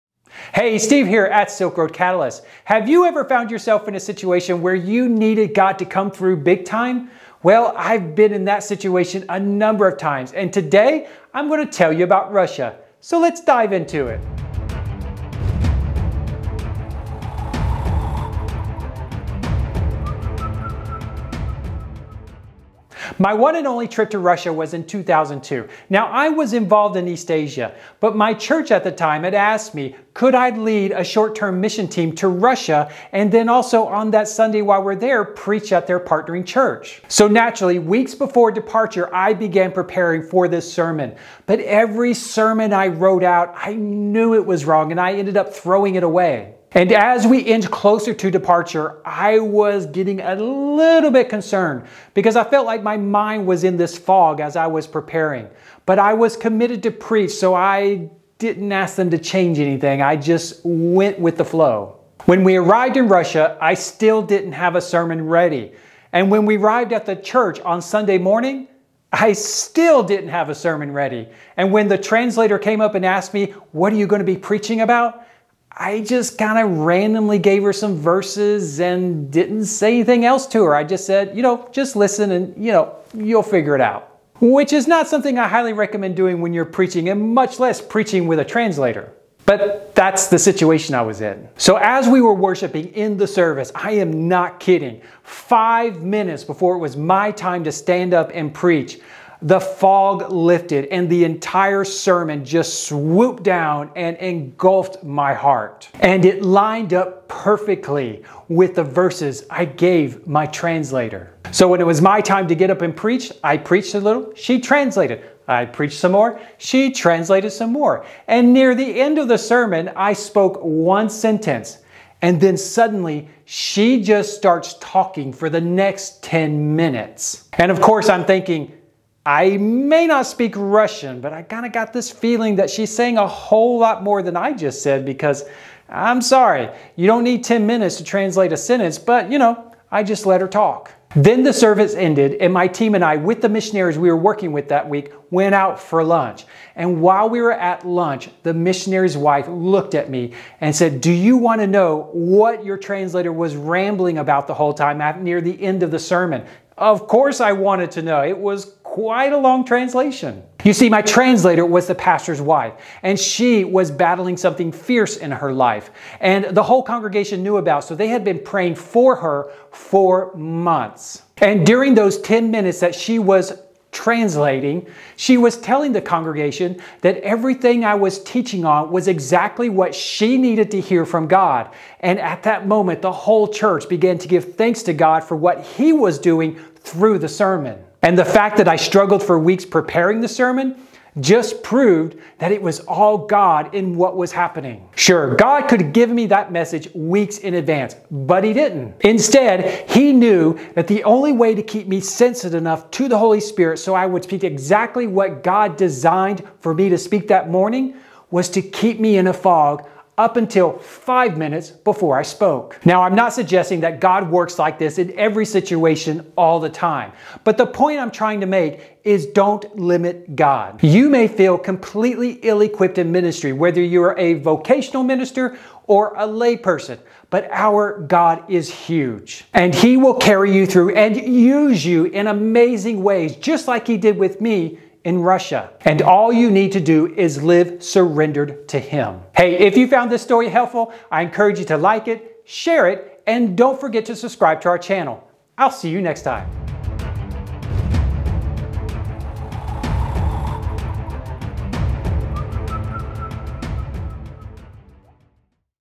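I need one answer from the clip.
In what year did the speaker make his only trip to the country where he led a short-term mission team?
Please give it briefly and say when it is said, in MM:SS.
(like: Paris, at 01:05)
2002, at 00:24.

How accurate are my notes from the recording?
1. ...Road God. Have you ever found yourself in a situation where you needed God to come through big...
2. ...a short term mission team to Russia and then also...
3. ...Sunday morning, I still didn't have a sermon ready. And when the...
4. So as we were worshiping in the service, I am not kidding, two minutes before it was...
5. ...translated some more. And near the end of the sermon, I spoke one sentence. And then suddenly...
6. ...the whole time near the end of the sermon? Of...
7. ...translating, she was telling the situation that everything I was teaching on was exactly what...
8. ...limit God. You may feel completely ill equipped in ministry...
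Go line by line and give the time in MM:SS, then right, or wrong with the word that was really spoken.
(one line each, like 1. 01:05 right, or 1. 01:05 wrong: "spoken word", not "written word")
1. 00:01 wrong: "Catalyst", not "God"
2. 00:30 right
3. 01:07 right
4. 01:31 wrong: "five", not "two"
5. 01:56 right
6. 02:34 right
7. 02:53 wrong: "congregation", not "situation"
8. 03:39 right.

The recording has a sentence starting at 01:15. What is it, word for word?
I just kind of randomly gave her some verses and didn't say anything else to her.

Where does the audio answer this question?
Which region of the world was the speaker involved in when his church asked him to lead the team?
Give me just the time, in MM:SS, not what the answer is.
00:27.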